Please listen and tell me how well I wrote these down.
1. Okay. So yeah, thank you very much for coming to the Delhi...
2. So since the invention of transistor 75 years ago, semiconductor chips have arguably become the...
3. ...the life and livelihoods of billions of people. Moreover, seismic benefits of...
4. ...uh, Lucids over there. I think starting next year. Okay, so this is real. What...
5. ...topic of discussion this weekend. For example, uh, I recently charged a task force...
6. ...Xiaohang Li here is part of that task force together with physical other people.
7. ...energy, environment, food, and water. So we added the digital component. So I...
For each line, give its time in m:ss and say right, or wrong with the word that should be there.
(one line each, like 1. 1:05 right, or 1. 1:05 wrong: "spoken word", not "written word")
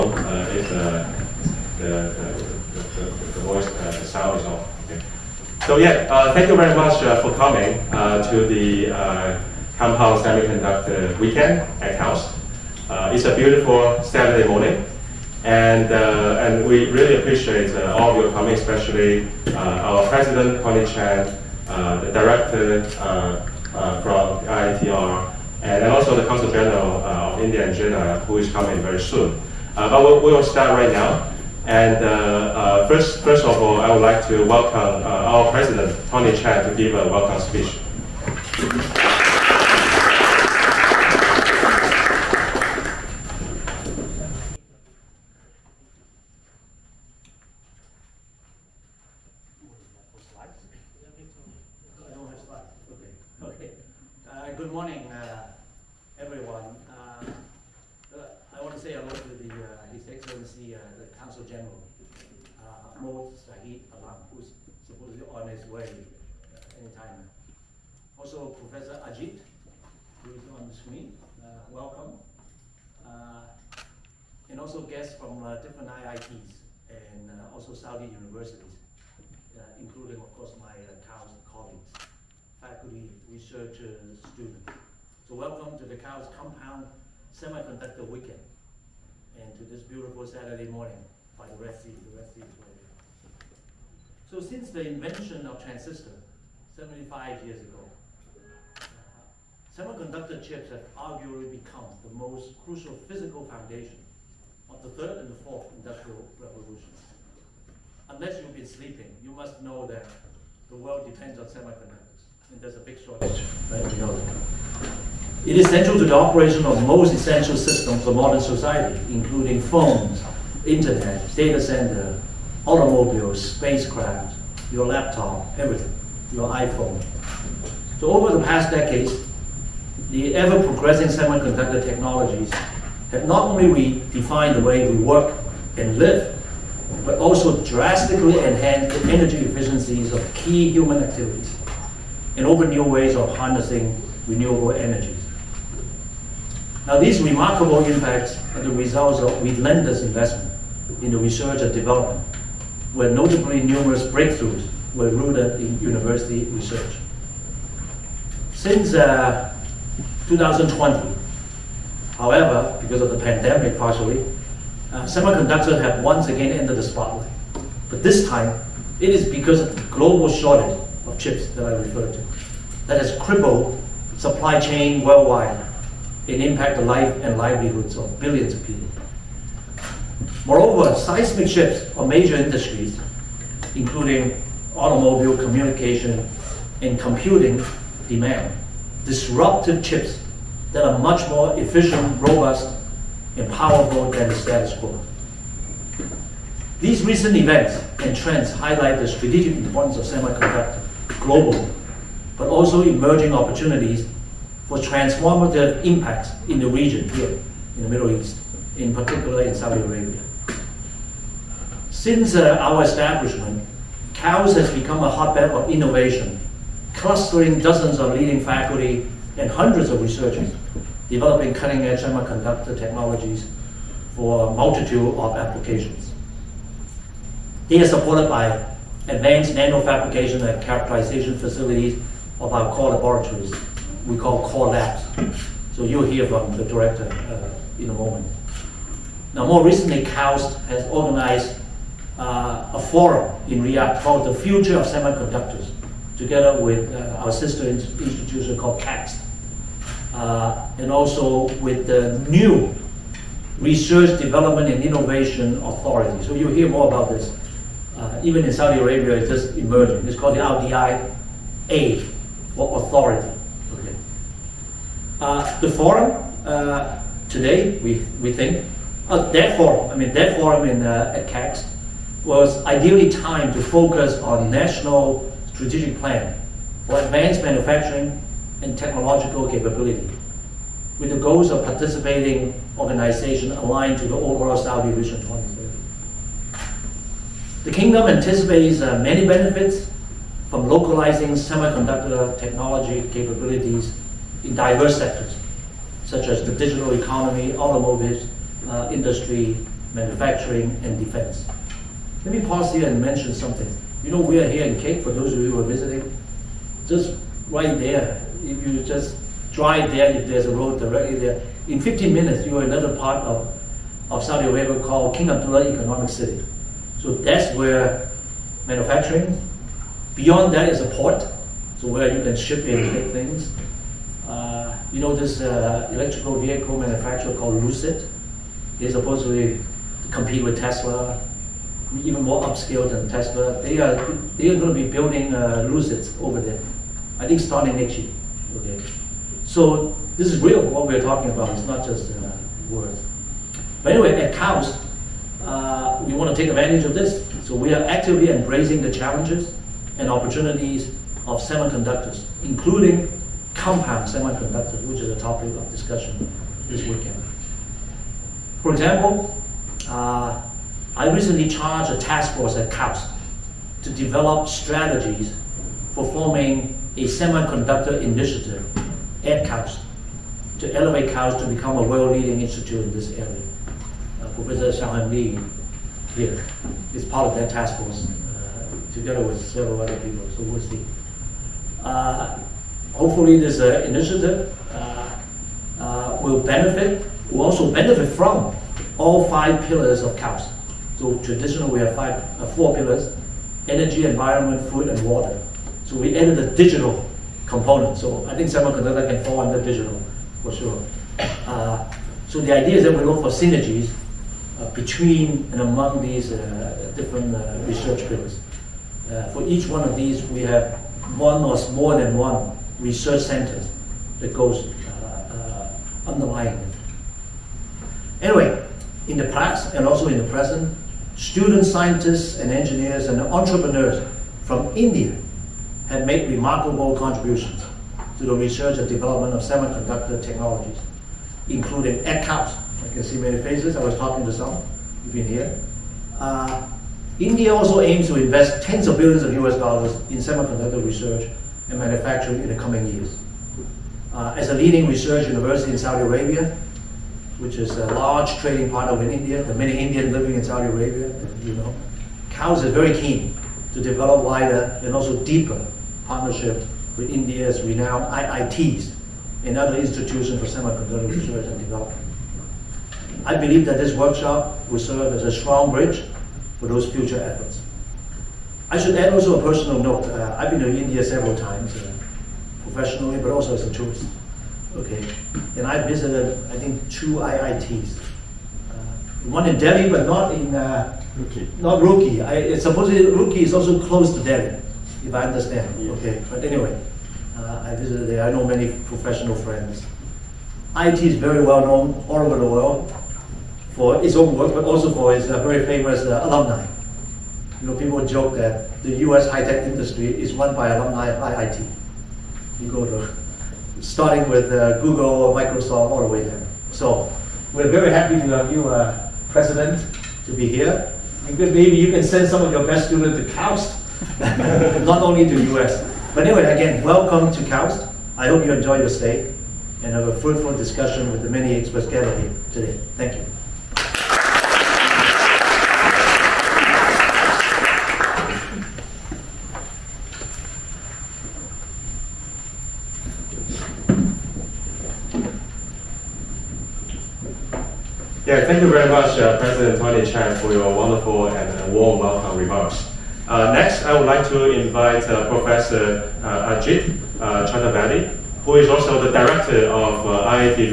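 1. 0:04 wrong: "Compound", not "Delhi"
2. 1:34 right
3. 2:56 wrong: "shifts", not "benefits"
4. 5:35 right
5. 5:55 right
6. 6:14 wrong: "several", not "physical"
7. 6:33 right.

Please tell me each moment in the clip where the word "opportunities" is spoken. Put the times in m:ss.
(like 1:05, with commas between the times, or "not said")
3:23, 5:50.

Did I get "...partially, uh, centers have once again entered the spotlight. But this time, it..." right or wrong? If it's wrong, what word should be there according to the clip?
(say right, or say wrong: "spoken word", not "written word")
wrong: "semiconductors", not "centers".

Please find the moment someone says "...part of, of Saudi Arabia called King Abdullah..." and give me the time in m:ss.
5:12.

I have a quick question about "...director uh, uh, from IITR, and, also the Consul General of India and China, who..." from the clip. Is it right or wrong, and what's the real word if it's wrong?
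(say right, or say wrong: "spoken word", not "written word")
right.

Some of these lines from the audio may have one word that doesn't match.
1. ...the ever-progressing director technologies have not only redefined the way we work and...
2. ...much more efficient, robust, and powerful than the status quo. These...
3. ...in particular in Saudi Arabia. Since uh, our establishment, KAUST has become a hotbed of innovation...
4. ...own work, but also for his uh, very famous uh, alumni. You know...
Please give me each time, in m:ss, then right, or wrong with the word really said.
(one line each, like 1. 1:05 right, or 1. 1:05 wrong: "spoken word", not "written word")
1. 2:10 wrong: "semiconductor", not "director"
2. 3:10 right
3. 3:28 right
4. 8:14 right.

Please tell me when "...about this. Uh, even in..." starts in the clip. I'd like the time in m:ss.
4:16.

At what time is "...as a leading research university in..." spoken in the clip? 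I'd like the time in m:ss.
7:24.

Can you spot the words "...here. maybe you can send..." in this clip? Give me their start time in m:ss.
8:30.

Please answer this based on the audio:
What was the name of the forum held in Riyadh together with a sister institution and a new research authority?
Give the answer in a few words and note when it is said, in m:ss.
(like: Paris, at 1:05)
Future of Semiconductors, at 4:04.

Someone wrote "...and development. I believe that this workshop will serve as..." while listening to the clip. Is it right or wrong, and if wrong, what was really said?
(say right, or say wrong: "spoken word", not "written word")
right.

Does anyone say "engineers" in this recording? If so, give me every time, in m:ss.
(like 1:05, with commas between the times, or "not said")
7:02.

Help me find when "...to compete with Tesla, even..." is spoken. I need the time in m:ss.
5:29.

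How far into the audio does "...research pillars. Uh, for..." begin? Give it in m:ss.
6:47.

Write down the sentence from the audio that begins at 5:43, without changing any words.
But anyway, at KAUST, uh, we want to take advantage of this.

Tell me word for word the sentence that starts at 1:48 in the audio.
Unless you've been sleeping, you must know that the world depends on semiconductors, and there's a big shortage, right?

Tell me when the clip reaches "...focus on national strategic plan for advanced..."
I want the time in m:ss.
4:33.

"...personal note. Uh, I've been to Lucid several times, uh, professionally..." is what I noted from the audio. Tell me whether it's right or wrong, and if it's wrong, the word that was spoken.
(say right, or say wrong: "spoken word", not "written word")
wrong: "India", not "Lucid".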